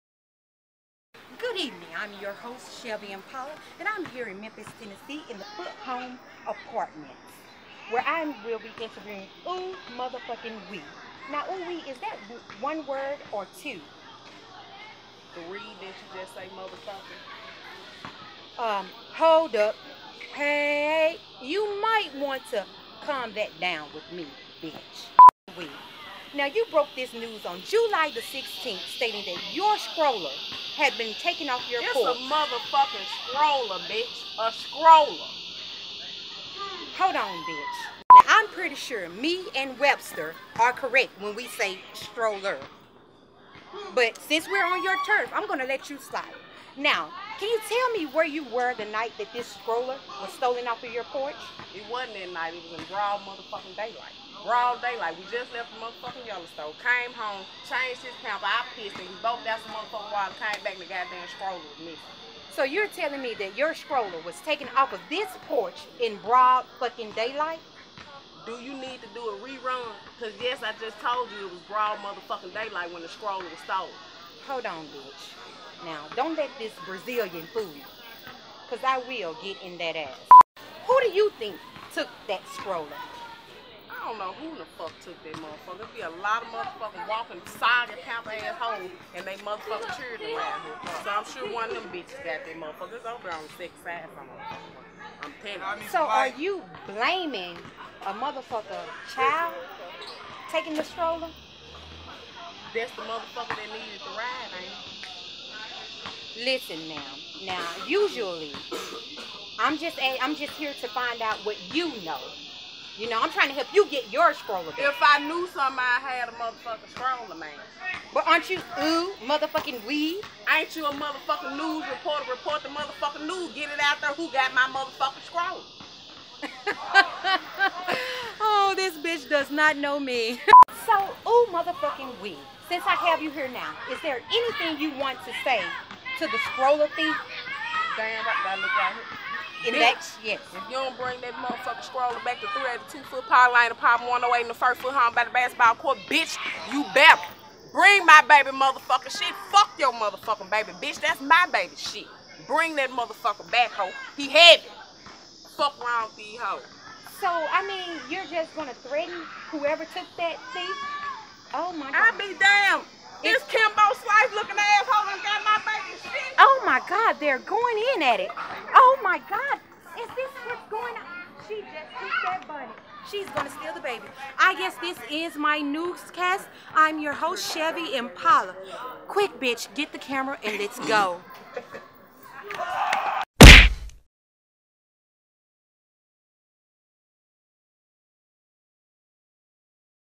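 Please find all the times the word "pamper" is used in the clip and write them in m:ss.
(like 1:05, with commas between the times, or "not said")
0:58, 1:28.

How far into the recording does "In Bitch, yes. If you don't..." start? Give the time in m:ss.
2:19.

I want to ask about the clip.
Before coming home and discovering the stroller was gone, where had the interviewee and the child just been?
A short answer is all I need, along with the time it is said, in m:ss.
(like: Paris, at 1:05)
Yellowstone, at 0:56.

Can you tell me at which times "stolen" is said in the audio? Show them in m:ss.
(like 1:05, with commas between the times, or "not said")
0:50, 1:13.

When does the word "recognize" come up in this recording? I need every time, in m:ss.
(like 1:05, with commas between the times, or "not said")
not said.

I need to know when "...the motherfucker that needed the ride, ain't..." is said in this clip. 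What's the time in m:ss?
1:42.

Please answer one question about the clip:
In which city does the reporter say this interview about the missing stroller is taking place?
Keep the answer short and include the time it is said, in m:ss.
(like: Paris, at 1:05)
Memphis, Tennessee, at 0:04.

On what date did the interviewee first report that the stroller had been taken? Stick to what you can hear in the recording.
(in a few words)
July 16.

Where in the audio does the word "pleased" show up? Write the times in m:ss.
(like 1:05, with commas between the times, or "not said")
not said.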